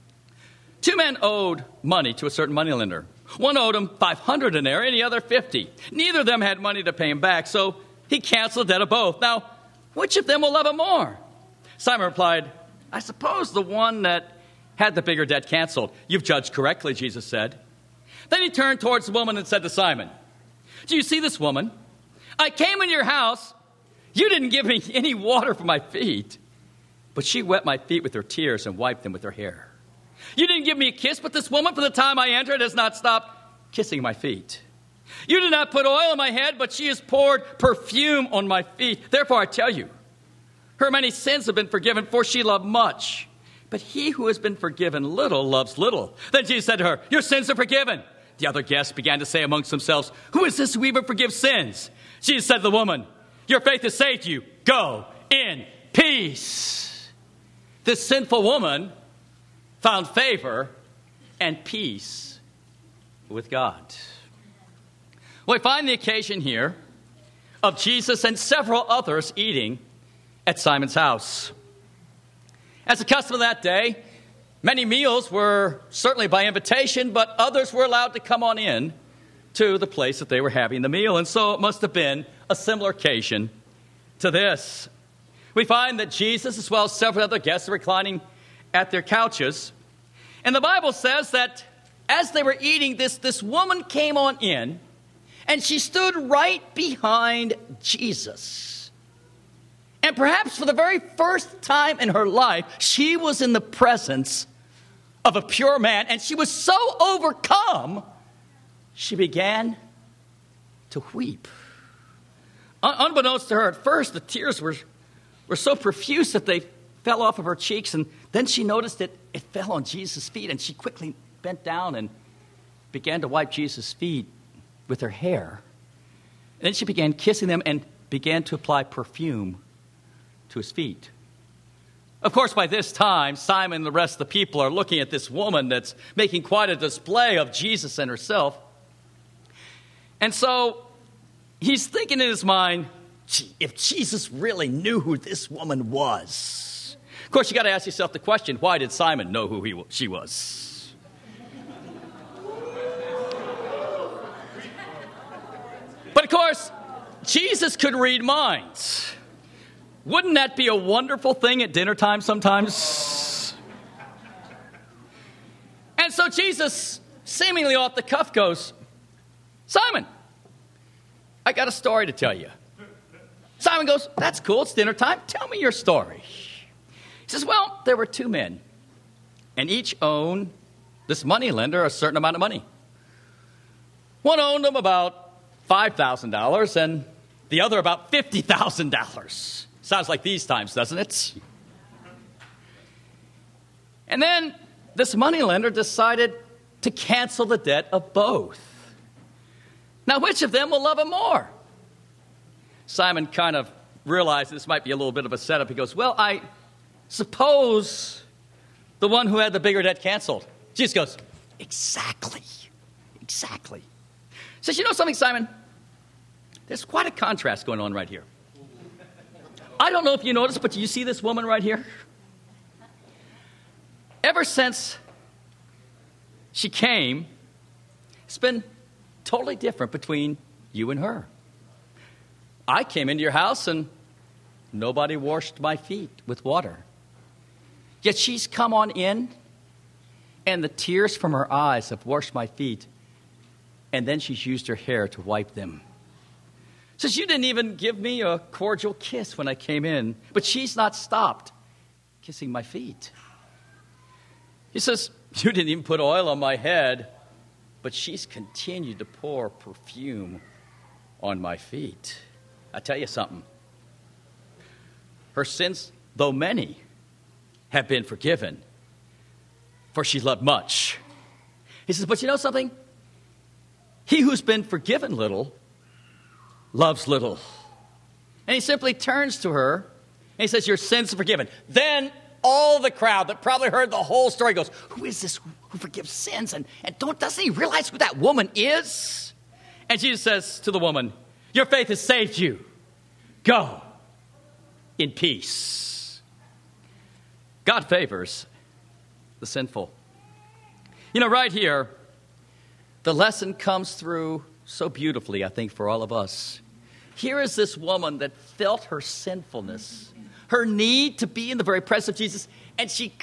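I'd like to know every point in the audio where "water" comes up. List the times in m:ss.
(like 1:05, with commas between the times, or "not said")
0:25, 3:56.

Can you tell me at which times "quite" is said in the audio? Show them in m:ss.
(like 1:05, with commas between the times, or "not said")
2:16, 3:36.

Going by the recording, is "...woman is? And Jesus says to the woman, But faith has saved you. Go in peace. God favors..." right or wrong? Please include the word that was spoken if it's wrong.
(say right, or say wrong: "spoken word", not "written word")
wrong: "Your", not "But".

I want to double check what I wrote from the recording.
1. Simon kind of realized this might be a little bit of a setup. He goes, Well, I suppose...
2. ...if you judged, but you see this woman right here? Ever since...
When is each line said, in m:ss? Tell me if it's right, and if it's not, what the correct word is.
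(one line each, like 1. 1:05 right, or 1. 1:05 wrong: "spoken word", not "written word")
1. 3:22 right
2. 3:40 wrong: "noticed", not "judged".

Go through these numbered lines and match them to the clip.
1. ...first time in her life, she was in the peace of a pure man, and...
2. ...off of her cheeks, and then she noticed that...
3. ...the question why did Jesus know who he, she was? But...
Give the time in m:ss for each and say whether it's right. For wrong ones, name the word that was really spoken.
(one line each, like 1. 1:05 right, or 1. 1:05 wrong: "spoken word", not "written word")
1. 1:41 wrong: "presence", not "peace"
2. 1:57 right
3. 2:28 wrong: "Simon", not "Jesus".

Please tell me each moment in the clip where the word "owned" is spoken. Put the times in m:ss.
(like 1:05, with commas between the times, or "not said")
3:00, 3:04.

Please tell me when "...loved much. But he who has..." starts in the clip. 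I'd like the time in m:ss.
0:42.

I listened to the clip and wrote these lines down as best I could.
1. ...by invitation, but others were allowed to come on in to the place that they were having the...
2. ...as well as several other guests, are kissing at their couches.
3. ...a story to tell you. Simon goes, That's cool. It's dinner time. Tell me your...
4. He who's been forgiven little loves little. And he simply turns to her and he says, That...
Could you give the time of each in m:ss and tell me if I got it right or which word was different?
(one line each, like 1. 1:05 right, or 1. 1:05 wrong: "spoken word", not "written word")
1. 1:16 right
2. 1:26 wrong: "reclining", not "kissing"
3. 2:51 right
4. 4:34 wrong: "Your", not "That".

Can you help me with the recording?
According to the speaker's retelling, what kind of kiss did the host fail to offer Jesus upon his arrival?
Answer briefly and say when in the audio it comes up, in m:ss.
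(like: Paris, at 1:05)
cordial kiss, at 4:08.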